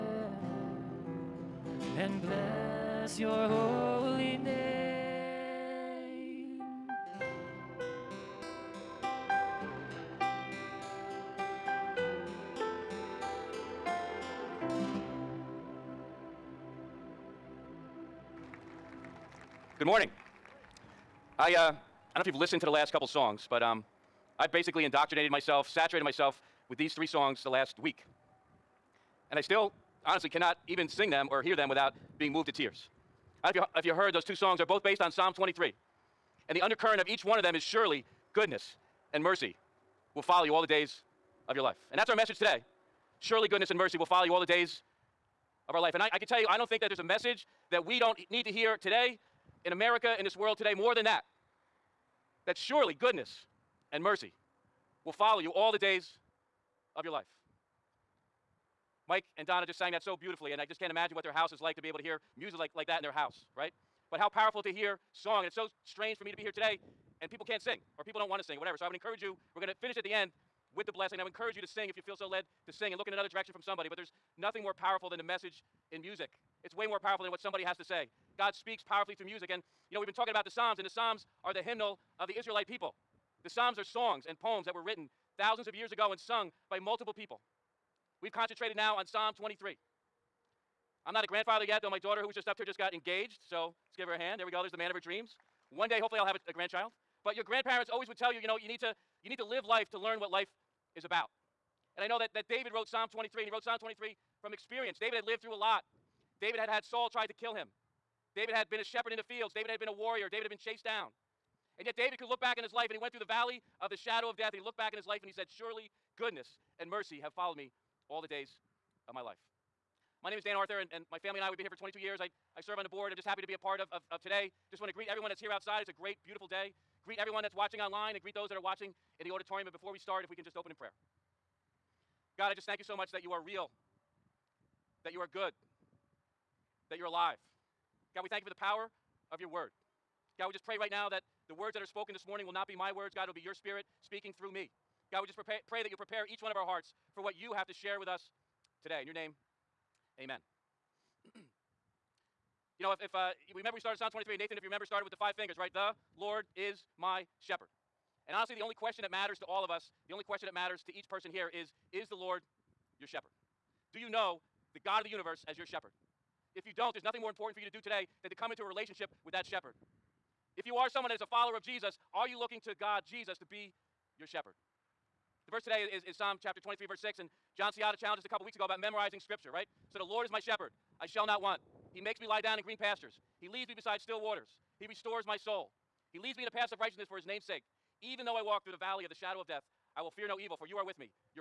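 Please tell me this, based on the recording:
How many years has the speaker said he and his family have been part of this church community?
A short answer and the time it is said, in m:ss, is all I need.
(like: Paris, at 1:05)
22, at 2:01.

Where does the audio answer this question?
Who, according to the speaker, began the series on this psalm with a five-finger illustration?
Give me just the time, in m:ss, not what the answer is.
2:34.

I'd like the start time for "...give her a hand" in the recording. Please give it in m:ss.
1:33.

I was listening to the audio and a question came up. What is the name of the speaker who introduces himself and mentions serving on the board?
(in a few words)
Dan Arthur.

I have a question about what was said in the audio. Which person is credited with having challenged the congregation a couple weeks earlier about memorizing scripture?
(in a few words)
John Ciotta.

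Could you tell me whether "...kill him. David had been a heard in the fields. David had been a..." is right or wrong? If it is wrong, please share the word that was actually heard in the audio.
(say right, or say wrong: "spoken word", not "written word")
wrong: "shepherd", not "heard".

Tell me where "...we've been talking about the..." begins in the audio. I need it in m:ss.
1:19.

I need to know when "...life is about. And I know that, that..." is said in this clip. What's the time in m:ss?
1:40.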